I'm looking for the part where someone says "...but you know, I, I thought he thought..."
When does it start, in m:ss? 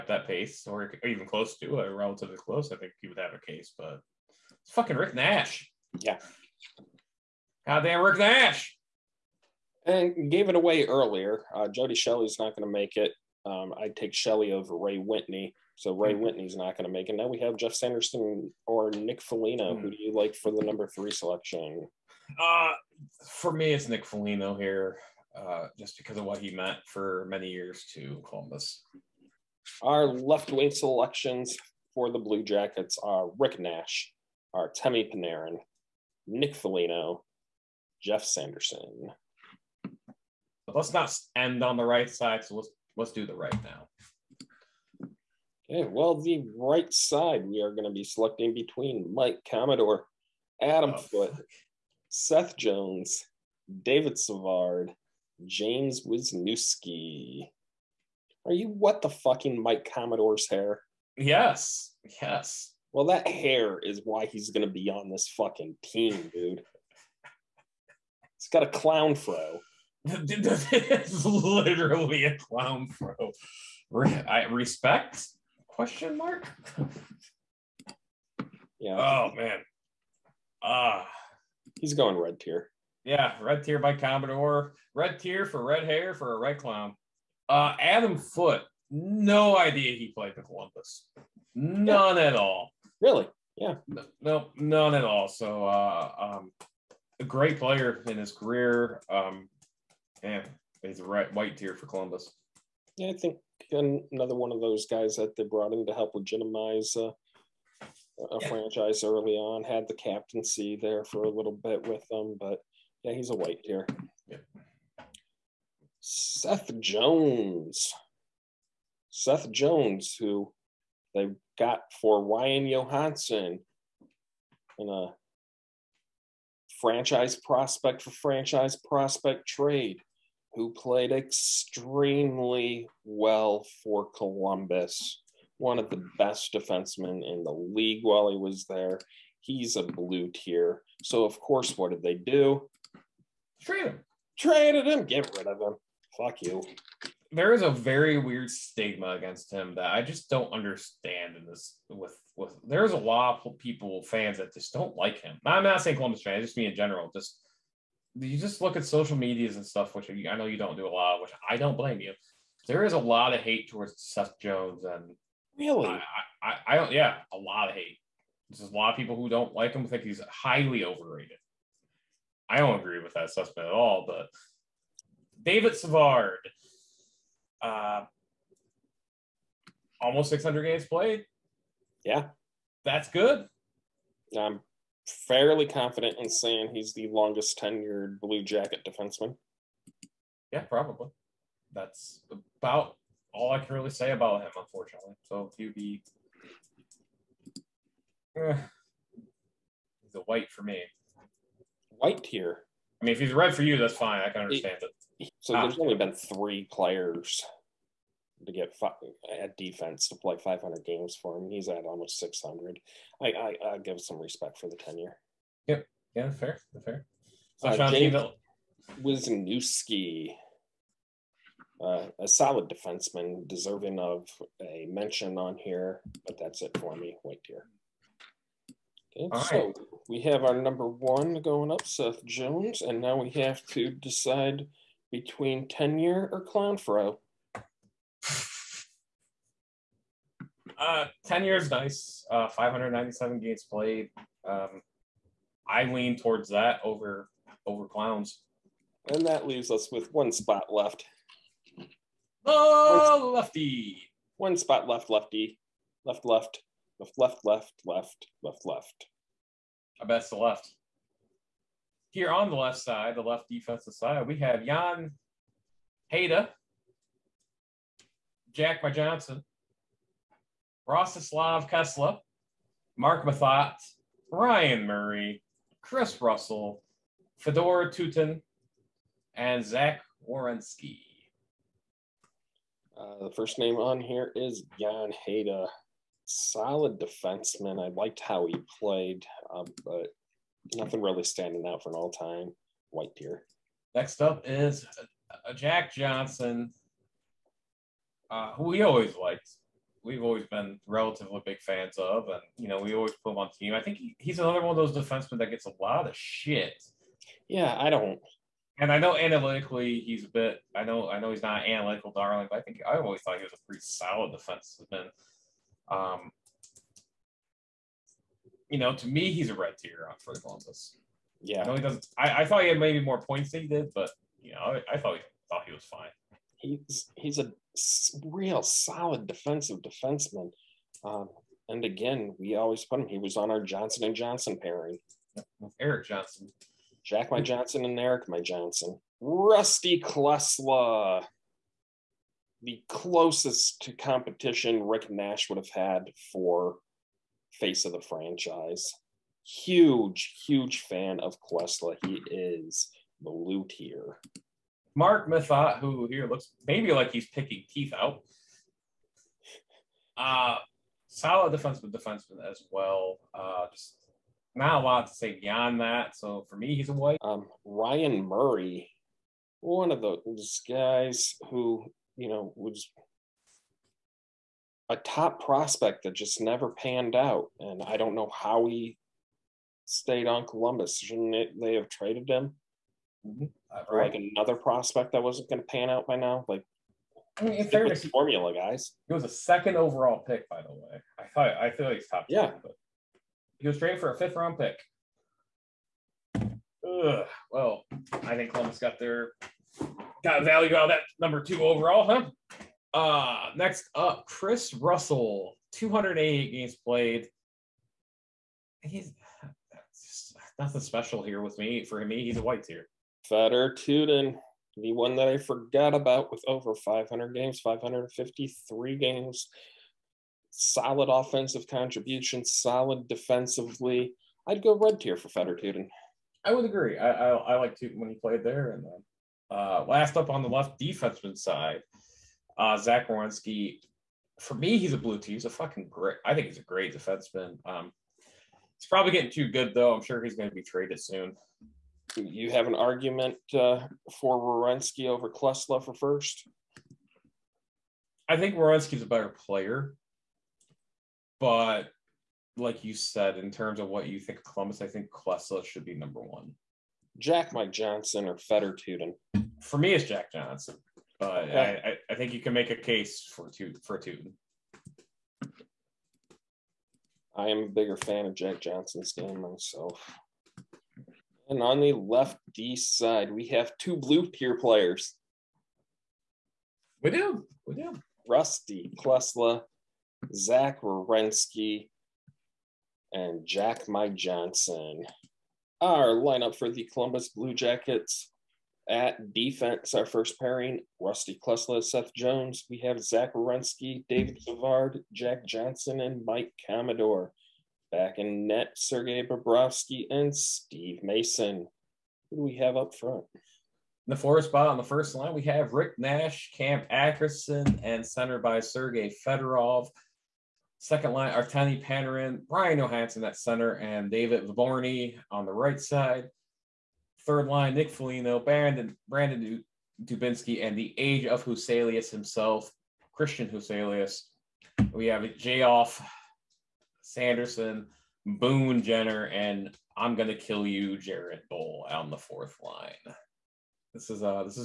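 5:23.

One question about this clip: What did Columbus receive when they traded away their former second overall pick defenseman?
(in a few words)
a fifth round pick.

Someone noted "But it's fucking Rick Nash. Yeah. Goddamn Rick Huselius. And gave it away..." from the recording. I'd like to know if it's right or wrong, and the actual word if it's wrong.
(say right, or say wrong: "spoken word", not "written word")
wrong: "Nash", not "Huselius".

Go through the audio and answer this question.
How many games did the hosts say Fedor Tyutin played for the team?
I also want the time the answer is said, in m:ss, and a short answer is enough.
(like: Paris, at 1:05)
553, at 6:57.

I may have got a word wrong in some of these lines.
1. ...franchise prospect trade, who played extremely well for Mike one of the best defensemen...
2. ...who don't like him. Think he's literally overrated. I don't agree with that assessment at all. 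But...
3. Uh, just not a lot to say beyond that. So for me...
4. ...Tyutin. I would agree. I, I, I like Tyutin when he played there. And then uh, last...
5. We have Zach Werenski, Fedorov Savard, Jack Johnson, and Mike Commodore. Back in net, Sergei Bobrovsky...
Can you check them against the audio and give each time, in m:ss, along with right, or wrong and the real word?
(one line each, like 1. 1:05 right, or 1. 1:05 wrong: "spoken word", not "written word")
1. 2:08 wrong: "Columbus", not "Mike"
2. 2:49 wrong: "highly", not "literally"
3. 6:03 right
4. 7:05 right
5. 8:12 wrong: "David", not "Fedorov".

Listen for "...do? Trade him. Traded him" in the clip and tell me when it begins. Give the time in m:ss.
2:22.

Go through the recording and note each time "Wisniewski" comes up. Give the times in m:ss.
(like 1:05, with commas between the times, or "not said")
0:56, 3:39.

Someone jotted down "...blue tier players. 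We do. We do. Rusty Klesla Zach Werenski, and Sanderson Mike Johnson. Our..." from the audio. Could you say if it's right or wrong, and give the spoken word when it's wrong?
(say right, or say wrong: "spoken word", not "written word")
wrong: "Jack", not "Sanderson".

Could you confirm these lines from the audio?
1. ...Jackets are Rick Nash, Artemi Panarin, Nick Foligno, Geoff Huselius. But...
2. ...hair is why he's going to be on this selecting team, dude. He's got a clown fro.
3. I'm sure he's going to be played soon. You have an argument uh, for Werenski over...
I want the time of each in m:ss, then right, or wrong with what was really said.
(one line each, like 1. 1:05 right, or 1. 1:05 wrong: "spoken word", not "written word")
1. 0:32 wrong: "Sanderson", not "Huselius"
2. 1:03 wrong: "fucking", not "selecting"
3. 7:19 wrong: "traded", not "played".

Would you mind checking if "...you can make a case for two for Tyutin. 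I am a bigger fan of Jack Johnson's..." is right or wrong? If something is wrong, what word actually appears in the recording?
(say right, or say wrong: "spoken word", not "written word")
right.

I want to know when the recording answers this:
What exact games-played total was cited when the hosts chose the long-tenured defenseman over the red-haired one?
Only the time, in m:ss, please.
4:02.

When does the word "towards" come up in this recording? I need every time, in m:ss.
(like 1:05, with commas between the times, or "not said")
2:43, 4:06.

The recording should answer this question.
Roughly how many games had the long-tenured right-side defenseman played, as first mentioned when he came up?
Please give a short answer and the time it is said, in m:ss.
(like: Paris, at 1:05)
600, at 2:59.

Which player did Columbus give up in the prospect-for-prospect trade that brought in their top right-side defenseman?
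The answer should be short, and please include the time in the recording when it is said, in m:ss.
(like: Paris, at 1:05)
Ryan Johansen, at 2:02.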